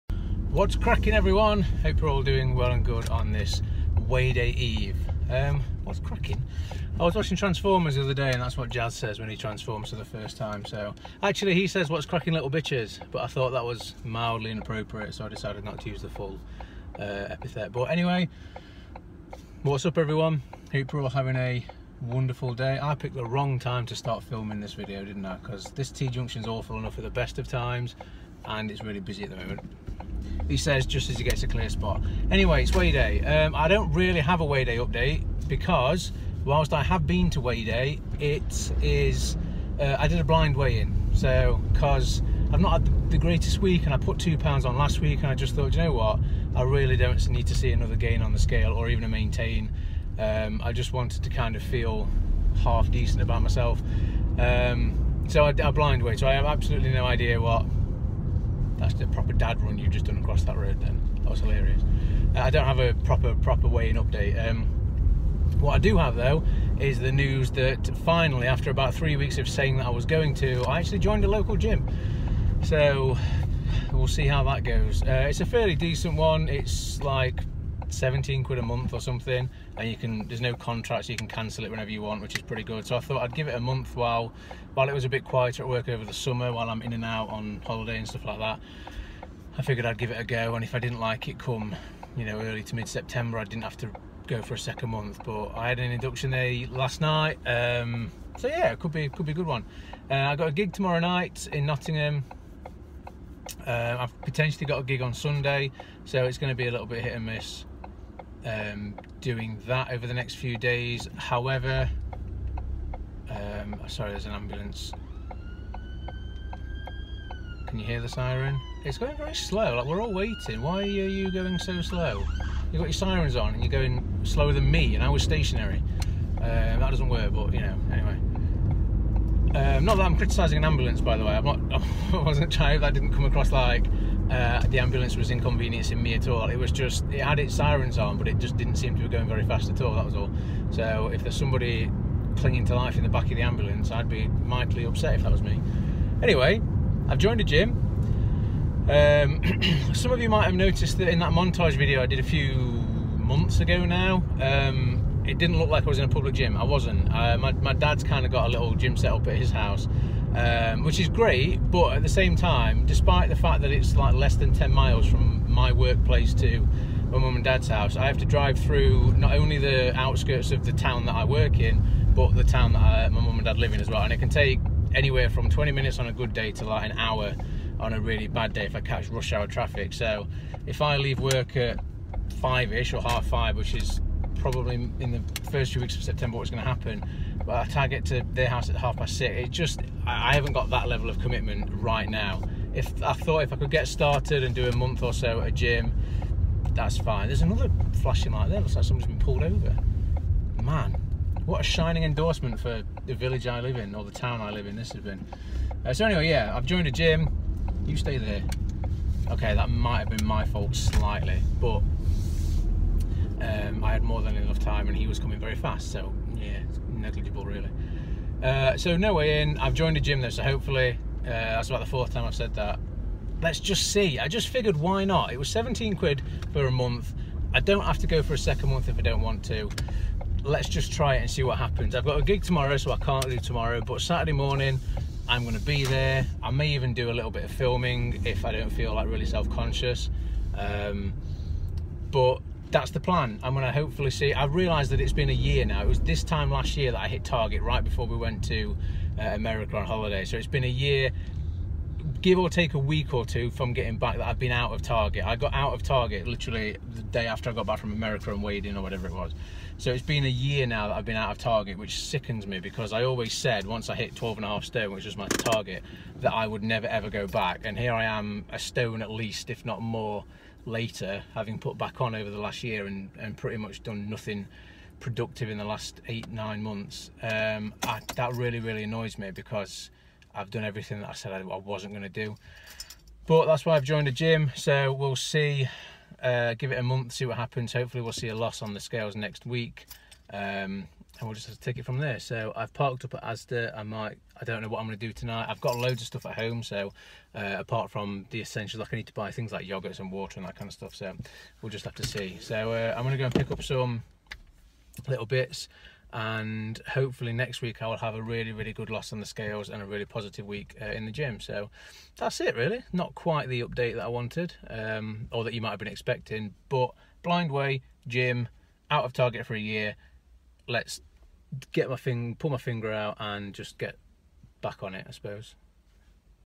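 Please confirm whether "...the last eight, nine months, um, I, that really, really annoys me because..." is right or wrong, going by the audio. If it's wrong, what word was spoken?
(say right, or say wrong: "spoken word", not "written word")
right.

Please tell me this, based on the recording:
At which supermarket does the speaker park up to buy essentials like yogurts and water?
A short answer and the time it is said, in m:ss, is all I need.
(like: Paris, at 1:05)
Asda, at 4:53.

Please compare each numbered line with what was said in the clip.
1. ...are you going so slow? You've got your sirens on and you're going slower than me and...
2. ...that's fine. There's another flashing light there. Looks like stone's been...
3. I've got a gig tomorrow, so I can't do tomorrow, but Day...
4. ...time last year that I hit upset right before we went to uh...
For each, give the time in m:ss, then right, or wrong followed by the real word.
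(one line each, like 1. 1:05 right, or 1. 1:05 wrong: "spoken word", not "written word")
1. 2:00 right
2. 3:16 wrong: "someone", not "stone"
3. 3:51 wrong: "Saturday", not "Day"
4. 4:06 wrong: "target", not "upset".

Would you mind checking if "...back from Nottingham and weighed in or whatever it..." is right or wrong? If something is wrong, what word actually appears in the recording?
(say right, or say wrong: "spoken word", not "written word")
wrong: "America", not "Nottingham".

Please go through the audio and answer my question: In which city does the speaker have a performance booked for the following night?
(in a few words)
Nottingham.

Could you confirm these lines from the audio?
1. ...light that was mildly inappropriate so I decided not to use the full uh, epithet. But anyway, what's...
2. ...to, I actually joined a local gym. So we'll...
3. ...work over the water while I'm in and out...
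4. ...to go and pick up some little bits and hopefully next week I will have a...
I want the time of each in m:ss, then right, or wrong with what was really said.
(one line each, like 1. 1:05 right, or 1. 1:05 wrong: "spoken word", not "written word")
1. 0:13 wrong: "thought", not "light"
2. 1:10 right
3. 1:25 wrong: "summer", not "water"
4. 5:03 right.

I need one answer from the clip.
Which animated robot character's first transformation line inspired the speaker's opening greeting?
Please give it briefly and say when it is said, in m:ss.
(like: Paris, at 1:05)
Jazz, at 0:08.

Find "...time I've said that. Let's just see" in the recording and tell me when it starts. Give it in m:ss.
3:42.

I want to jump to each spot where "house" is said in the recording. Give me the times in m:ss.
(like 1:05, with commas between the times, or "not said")
2:39, 2:47, 3:08.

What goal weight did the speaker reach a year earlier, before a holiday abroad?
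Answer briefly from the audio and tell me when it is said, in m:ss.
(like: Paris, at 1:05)
12 and a half stone, at 4:24.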